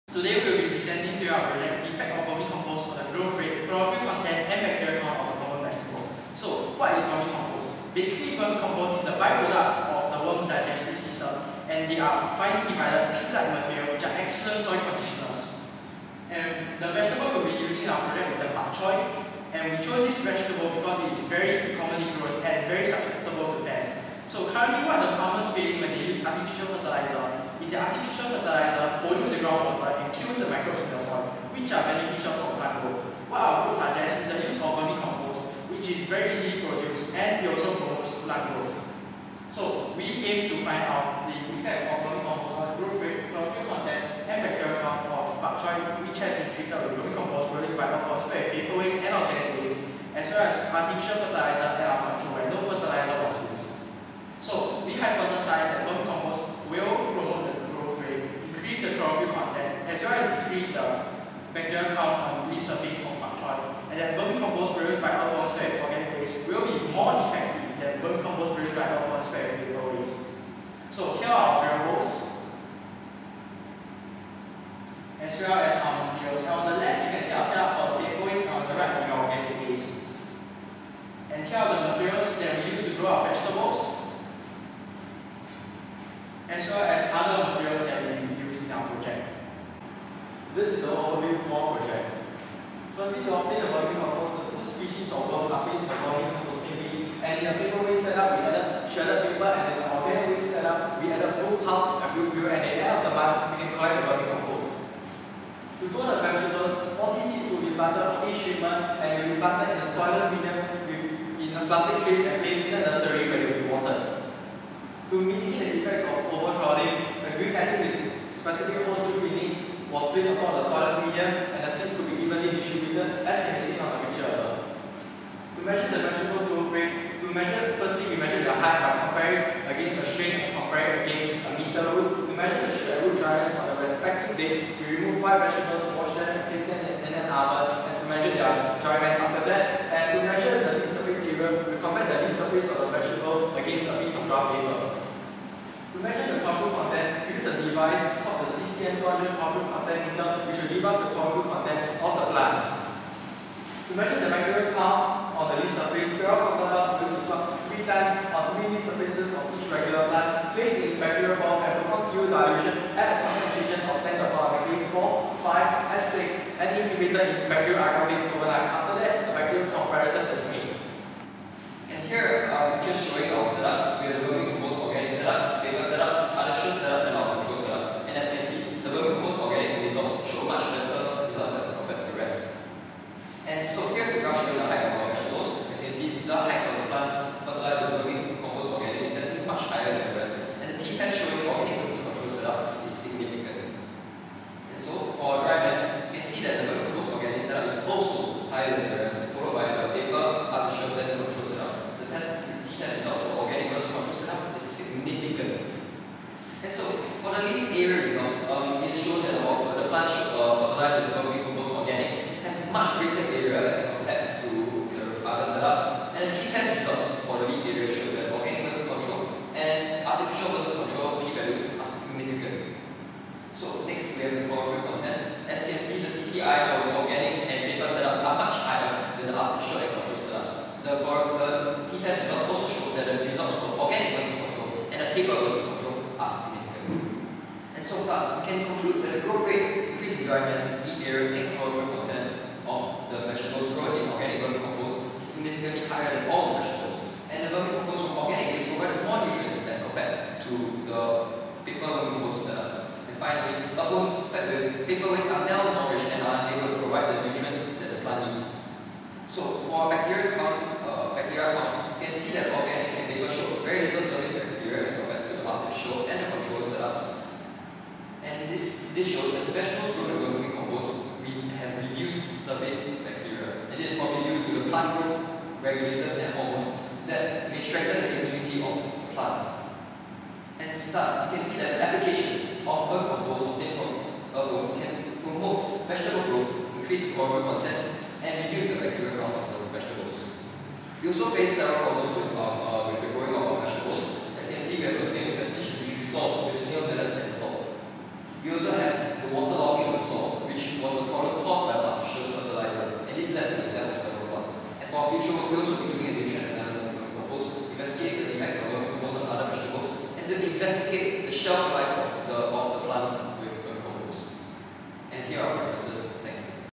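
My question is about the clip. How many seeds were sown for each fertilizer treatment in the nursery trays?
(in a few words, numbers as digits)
40.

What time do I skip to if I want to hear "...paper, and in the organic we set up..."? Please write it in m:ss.
1:39.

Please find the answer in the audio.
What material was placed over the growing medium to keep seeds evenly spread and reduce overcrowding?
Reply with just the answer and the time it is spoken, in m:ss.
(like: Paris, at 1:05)
green netting, at 1:57.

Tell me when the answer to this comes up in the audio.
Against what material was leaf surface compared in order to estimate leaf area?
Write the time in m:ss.
2:24.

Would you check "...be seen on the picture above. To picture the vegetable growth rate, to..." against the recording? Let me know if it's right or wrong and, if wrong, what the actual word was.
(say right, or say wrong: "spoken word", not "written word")
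wrong: "measure", not "picture".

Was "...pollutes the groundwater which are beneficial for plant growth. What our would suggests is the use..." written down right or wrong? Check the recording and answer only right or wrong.
right.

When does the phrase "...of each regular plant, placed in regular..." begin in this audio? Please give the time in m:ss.
2:39.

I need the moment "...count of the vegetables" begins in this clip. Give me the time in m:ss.
4:49.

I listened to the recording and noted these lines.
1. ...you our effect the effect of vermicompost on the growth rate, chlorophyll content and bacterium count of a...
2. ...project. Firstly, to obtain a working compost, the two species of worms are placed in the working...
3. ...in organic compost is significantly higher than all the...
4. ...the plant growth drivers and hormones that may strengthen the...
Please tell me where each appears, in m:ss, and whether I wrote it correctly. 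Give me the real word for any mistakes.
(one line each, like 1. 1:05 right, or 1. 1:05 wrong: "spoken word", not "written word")
1. 0:01 wrong: "project", not "effect"
2. 1:31 right
3. 4:04 right
4. 4:34 wrong: "regulators", not "drivers".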